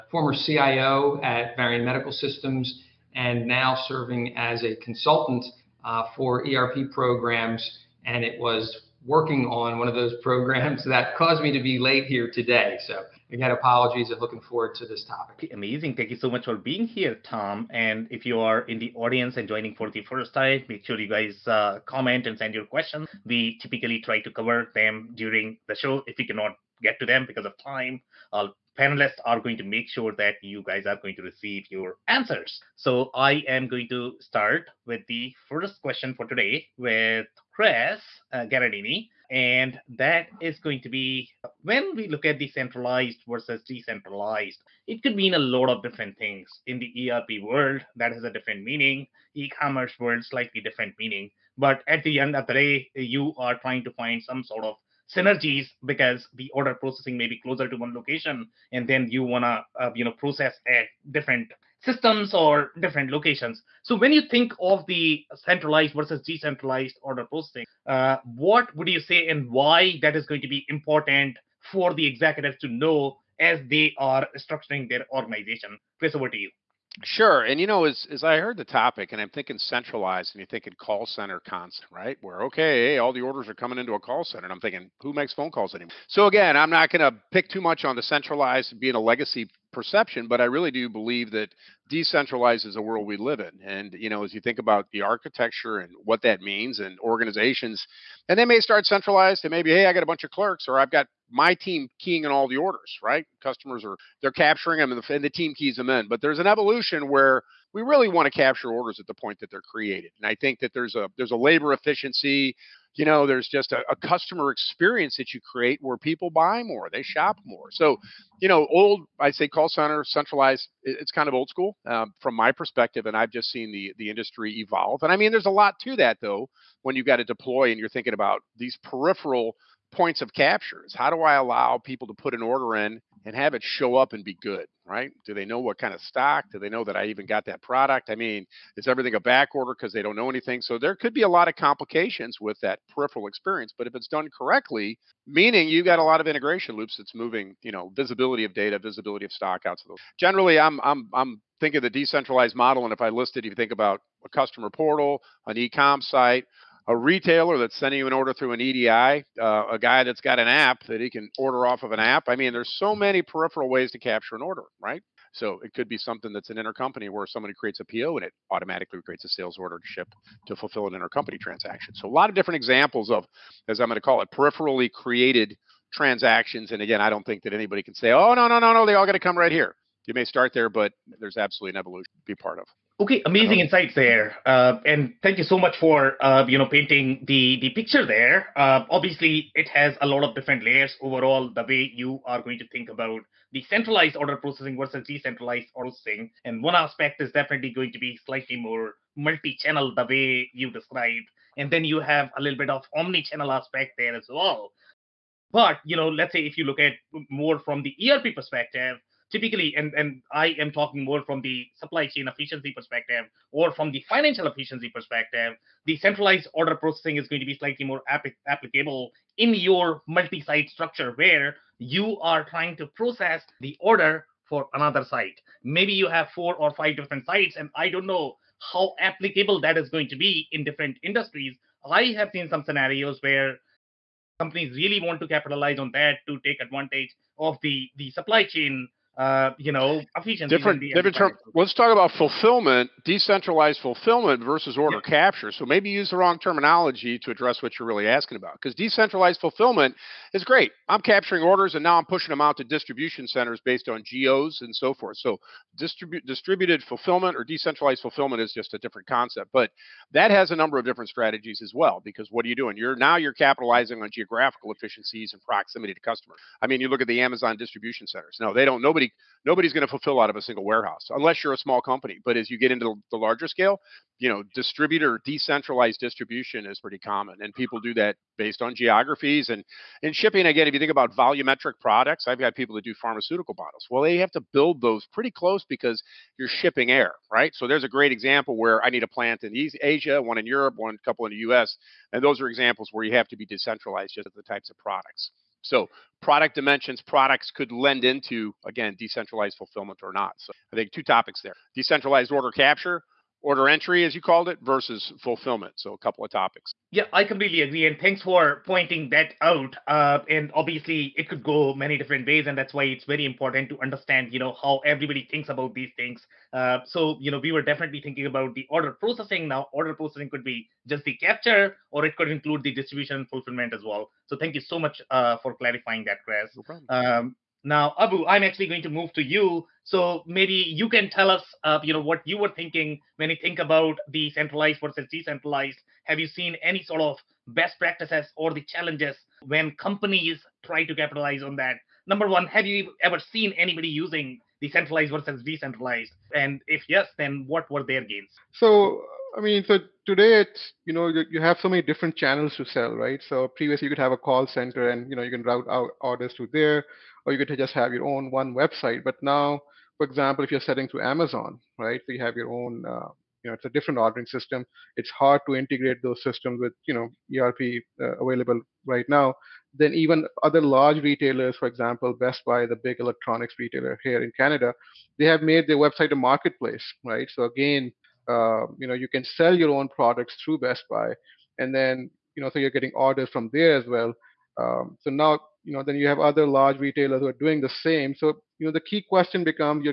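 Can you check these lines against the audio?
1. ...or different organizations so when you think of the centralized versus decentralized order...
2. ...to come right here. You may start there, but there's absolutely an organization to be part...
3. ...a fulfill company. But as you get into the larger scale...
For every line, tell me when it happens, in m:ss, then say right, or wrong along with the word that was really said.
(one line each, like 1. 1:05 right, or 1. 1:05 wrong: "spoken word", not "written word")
1. 1:02 wrong: "locations", not "organizations"
2. 2:59 wrong: "evolution", not "organization"
3. 4:31 wrong: "small", not "fulfill".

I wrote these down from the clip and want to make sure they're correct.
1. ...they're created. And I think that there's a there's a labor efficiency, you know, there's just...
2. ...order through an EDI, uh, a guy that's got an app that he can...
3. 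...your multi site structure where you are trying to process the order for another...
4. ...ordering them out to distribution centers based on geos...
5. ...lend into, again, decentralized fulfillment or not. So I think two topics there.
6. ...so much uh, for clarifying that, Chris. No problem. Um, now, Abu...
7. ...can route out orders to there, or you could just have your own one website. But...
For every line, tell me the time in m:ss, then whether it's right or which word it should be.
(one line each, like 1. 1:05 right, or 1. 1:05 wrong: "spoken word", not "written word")
1. 1:49 right
2. 2:38 right
3. 3:39 right
4. 4:12 wrong: "pushing", not "ordering"
5. 4:57 right
6. 5:24 right
7. 5:55 right.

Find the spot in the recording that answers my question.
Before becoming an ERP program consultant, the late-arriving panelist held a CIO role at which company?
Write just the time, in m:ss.
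0:01.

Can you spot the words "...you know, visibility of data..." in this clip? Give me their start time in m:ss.
2:27.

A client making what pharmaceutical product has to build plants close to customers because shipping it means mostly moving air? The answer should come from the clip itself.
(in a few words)
Pharmaceutical bottles.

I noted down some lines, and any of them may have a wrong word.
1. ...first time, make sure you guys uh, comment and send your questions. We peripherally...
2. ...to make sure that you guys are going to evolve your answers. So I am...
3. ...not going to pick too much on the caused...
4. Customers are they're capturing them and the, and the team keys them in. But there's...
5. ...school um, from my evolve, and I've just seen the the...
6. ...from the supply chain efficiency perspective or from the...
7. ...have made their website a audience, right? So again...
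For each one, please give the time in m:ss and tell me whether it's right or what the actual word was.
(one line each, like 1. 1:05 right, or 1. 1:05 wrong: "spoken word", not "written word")
1. 0:20 wrong: "typically", not "peripherally"
2. 0:29 wrong: "receive", not "evolve"
3. 1:26 wrong: "centralized", not "caused"
4. 1:43 right
5. 2:01 wrong: "perspective", not "evolve"
6. 3:31 right
7. 6:15 wrong: "marketplace", not "audience".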